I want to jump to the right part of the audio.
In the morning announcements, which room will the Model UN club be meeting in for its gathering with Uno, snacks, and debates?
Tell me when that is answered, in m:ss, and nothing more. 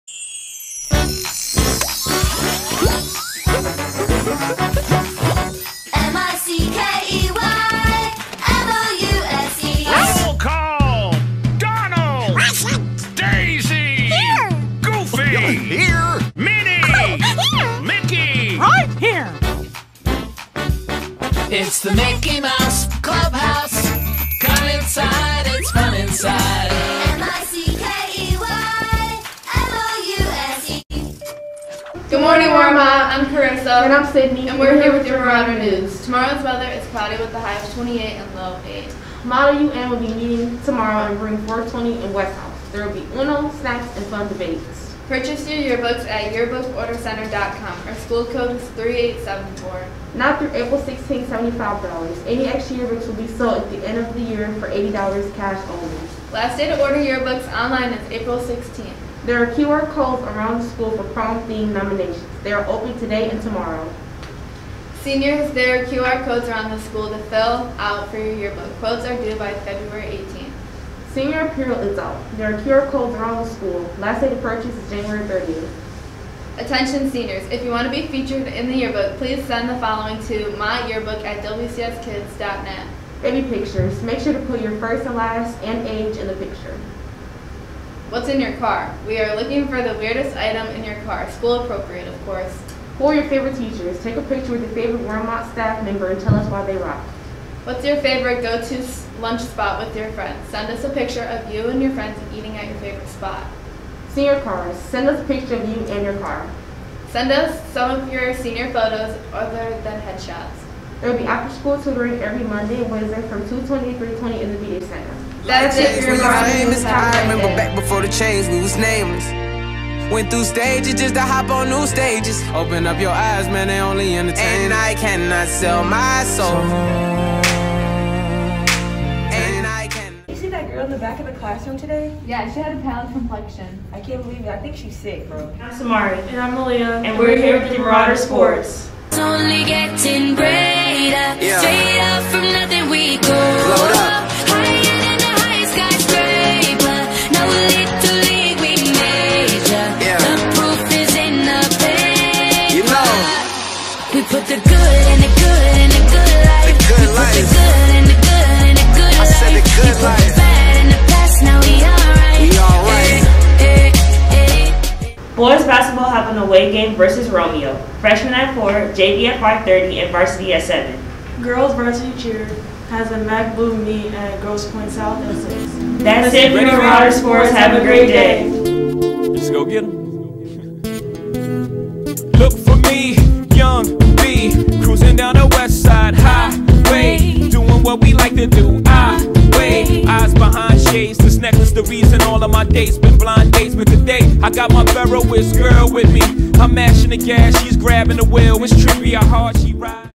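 0:41.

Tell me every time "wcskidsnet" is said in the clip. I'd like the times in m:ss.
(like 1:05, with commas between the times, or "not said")
1:21.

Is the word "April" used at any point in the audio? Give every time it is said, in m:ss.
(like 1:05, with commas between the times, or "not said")
0:50, 0:58.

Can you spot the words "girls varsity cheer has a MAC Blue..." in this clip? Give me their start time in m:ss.
2:51.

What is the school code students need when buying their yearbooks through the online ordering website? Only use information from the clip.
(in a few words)
3874.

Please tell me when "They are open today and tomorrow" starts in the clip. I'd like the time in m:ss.
1:02.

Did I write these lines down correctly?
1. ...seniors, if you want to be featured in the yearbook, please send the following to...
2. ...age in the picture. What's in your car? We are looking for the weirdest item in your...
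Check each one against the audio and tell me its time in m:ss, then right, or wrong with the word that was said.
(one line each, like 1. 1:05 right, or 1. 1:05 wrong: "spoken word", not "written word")
1. 1:17 right
2. 1:25 right.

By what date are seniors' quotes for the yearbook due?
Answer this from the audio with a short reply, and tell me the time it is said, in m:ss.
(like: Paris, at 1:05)
February 18th, at 1:09.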